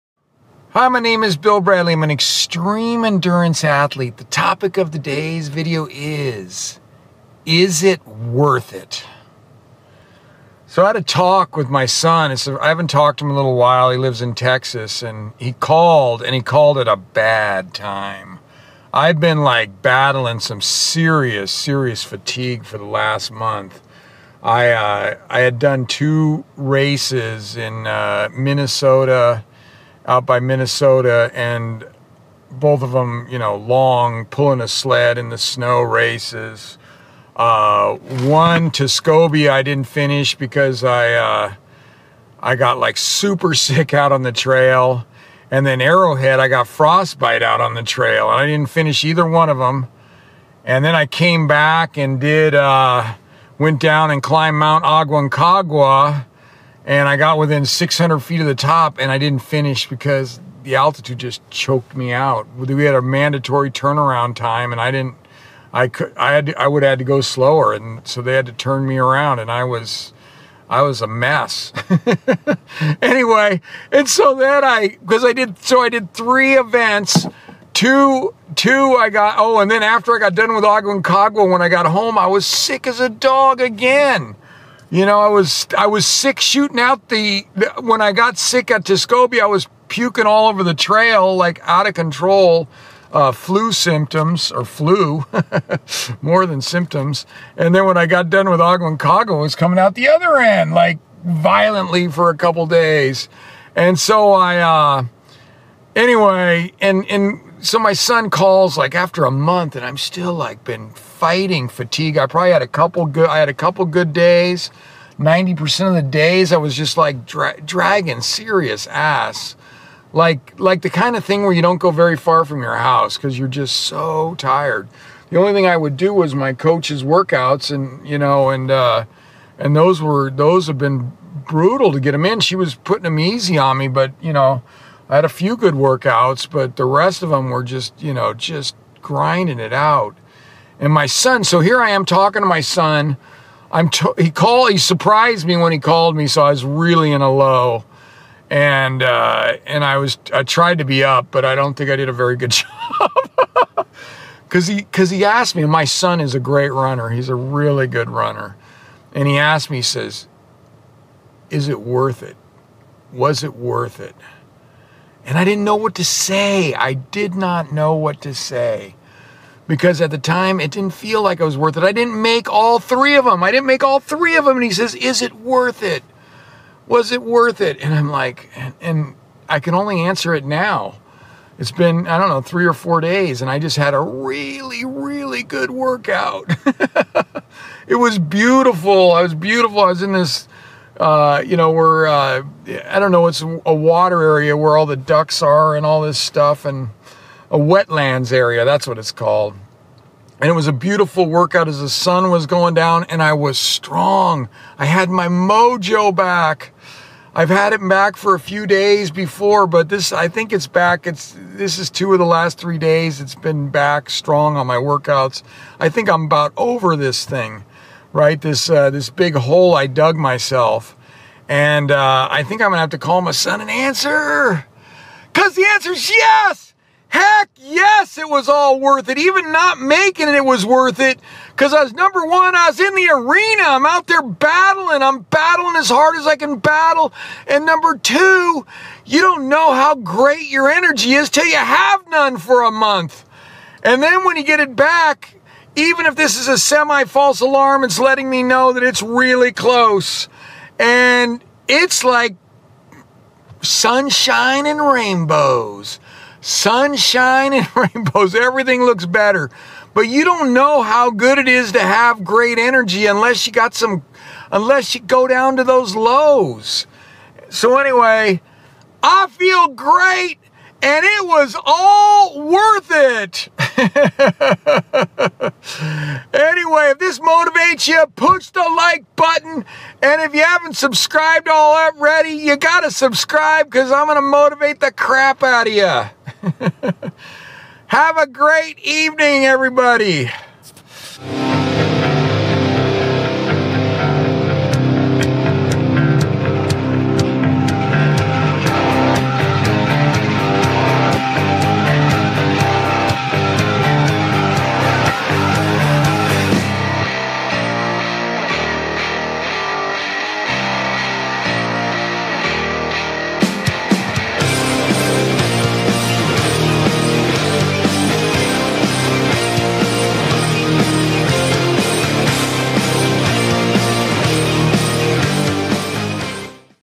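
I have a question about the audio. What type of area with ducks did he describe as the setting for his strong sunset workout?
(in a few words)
A wetlands area.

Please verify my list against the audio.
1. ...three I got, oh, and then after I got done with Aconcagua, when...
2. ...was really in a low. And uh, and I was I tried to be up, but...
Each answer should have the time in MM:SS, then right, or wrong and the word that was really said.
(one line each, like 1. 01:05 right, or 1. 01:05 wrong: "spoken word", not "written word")
1. 01:18 wrong: "two", not "three"
2. 02:26 right.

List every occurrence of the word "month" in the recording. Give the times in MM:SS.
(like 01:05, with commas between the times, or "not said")
00:23, 01:49, 04:02.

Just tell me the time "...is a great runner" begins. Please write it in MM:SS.
02:36.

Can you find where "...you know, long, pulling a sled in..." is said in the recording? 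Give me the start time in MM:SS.
00:33.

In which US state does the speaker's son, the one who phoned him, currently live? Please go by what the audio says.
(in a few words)
Texas.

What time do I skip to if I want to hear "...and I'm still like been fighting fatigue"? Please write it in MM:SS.
01:49.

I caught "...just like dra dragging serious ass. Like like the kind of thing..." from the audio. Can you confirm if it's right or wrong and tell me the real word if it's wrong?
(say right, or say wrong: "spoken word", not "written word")
right.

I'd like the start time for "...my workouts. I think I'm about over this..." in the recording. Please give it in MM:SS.
03:34.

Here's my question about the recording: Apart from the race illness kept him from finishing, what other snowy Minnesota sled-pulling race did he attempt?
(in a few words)
Arrowhead.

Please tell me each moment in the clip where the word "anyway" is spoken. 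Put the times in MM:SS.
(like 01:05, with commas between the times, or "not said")
01:13, 01:45, 04:27, 04:36.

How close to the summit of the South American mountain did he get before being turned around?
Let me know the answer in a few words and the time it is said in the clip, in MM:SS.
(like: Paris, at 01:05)
600 feet, at 00:57.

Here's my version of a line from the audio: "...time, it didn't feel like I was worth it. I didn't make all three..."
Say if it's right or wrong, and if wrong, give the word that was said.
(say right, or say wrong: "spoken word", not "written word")
right.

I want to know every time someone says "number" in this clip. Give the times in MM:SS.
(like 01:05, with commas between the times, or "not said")
03:51, 03:57.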